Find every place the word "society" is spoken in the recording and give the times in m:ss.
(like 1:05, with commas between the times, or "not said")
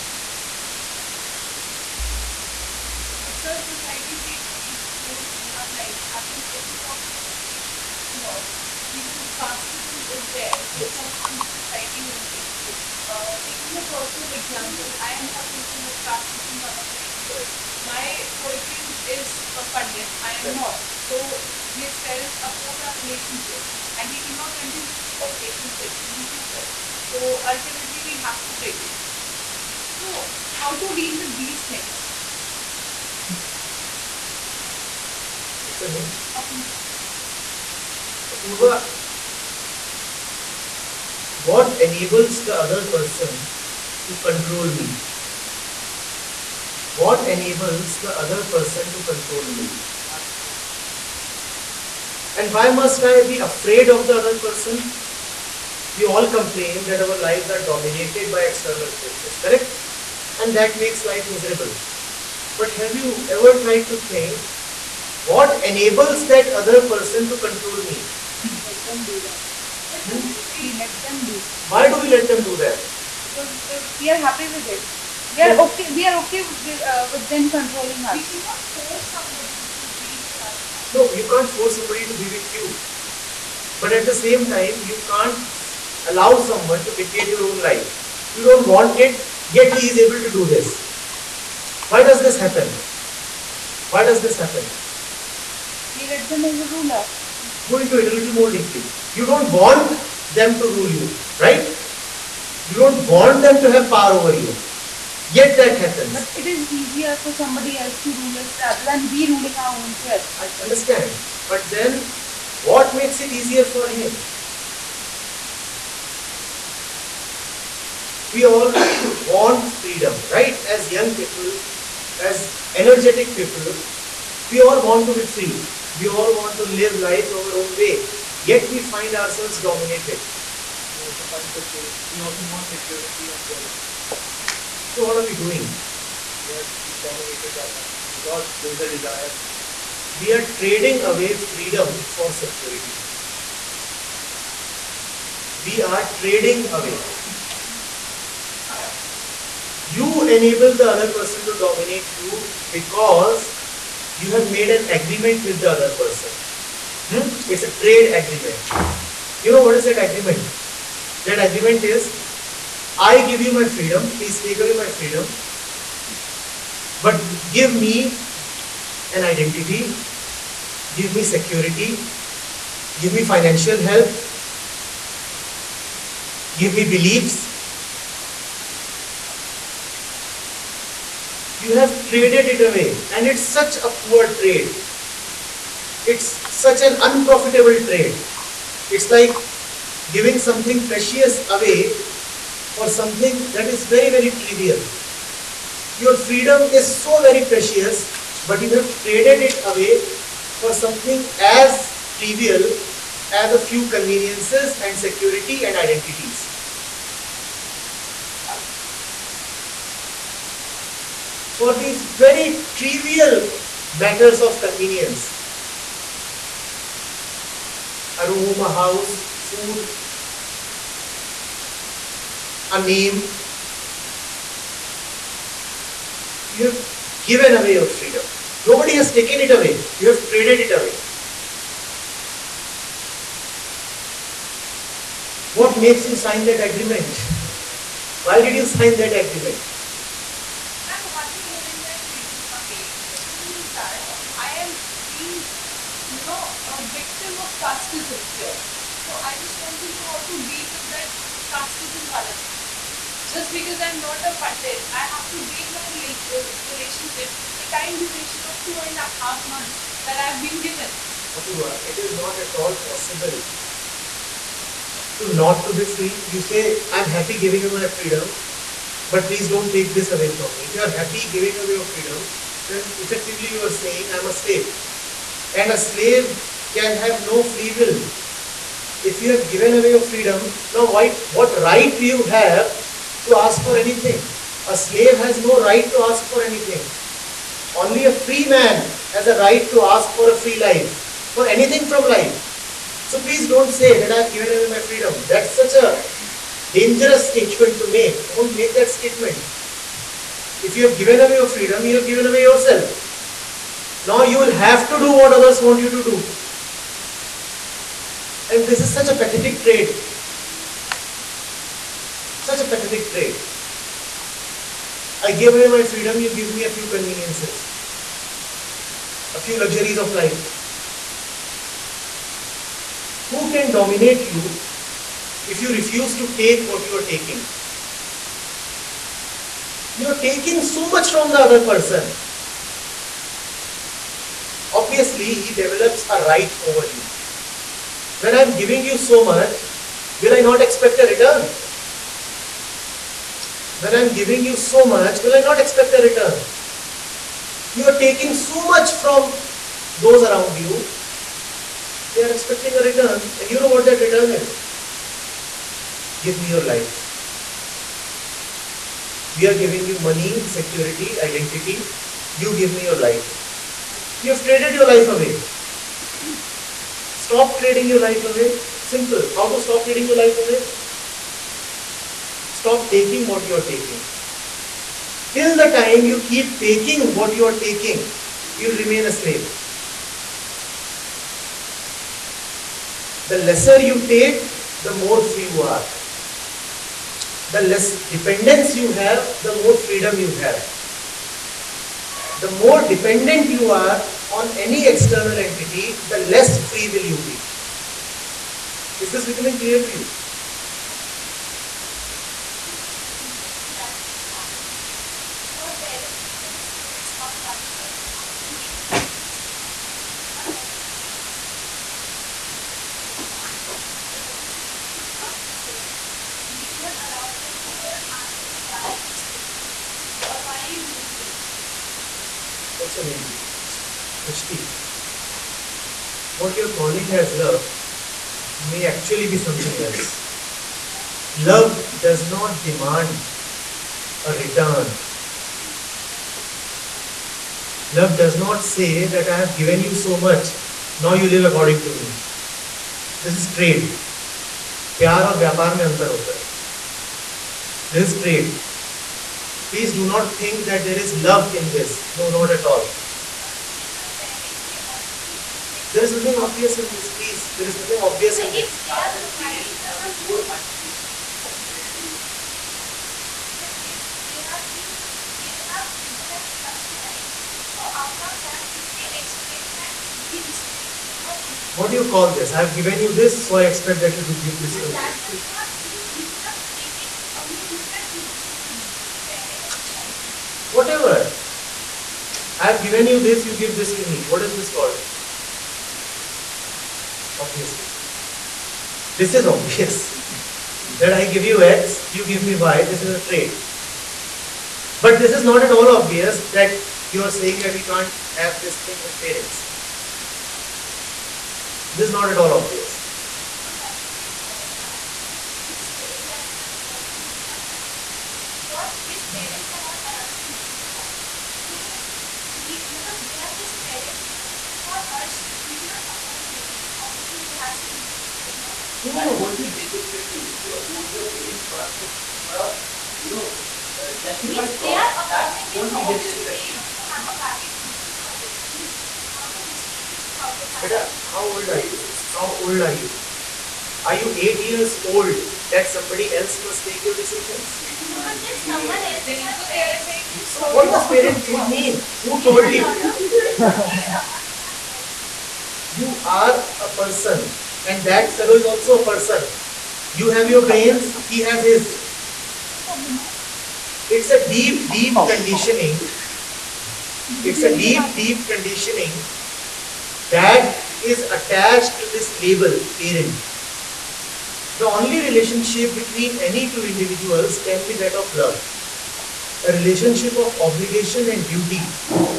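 0:03, 0:11.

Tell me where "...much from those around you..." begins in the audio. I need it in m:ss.
5:48.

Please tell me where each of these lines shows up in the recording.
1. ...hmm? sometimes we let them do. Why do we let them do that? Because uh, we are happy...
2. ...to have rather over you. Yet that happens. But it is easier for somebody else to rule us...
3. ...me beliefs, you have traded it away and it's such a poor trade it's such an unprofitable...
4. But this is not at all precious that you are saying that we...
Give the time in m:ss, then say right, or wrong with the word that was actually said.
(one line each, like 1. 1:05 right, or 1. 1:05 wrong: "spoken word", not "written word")
1. 1:10 right
2. 1:43 wrong: "power", not "rather"
3. 2:56 right
4. 8:14 wrong: "obvious", not "precious".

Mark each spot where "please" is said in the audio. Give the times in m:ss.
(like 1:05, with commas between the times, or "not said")
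2:44, 4:29, 4:53, 7:29, 7:37.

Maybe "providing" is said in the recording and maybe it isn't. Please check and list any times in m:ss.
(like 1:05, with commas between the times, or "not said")
7:39.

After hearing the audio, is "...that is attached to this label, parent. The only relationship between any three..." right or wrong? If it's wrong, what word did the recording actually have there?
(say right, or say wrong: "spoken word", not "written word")
wrong: "two", not "three".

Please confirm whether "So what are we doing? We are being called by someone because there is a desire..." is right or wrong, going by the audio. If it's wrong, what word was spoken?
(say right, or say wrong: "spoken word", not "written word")
wrong: "dominated", not "called".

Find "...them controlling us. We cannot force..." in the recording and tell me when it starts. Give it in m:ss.
1:17.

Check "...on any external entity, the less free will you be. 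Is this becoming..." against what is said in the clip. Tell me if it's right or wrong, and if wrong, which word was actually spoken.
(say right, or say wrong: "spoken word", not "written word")
right.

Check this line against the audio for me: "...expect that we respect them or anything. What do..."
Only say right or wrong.
right.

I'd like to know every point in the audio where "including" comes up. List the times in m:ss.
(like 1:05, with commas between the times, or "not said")
not said.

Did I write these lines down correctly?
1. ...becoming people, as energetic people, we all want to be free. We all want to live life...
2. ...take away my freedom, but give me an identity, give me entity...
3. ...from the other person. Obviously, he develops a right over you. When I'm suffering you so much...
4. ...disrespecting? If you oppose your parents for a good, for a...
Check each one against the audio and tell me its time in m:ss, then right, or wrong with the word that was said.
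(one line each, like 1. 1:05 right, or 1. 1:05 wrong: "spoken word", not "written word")
1. 2:00 wrong: "young", not "becoming"
2. 2:44 wrong: "security", not "entity"
3. 5:31 wrong: "giving", not "suffering"
4. 8:39 right.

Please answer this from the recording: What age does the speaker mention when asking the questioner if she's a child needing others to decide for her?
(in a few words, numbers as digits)
8.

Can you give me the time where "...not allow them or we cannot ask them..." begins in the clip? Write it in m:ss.
6:56.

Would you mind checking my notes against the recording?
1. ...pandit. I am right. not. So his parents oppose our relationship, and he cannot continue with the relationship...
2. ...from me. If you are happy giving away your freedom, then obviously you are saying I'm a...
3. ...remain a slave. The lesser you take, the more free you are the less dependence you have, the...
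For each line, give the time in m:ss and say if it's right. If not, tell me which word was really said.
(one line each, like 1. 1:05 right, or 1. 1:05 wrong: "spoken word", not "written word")
1. 0:19 right
2. 4:30 wrong: "effectively", not "obviously"
3. 6:18 right.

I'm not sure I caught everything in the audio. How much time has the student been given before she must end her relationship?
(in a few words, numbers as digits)
Two and a half months.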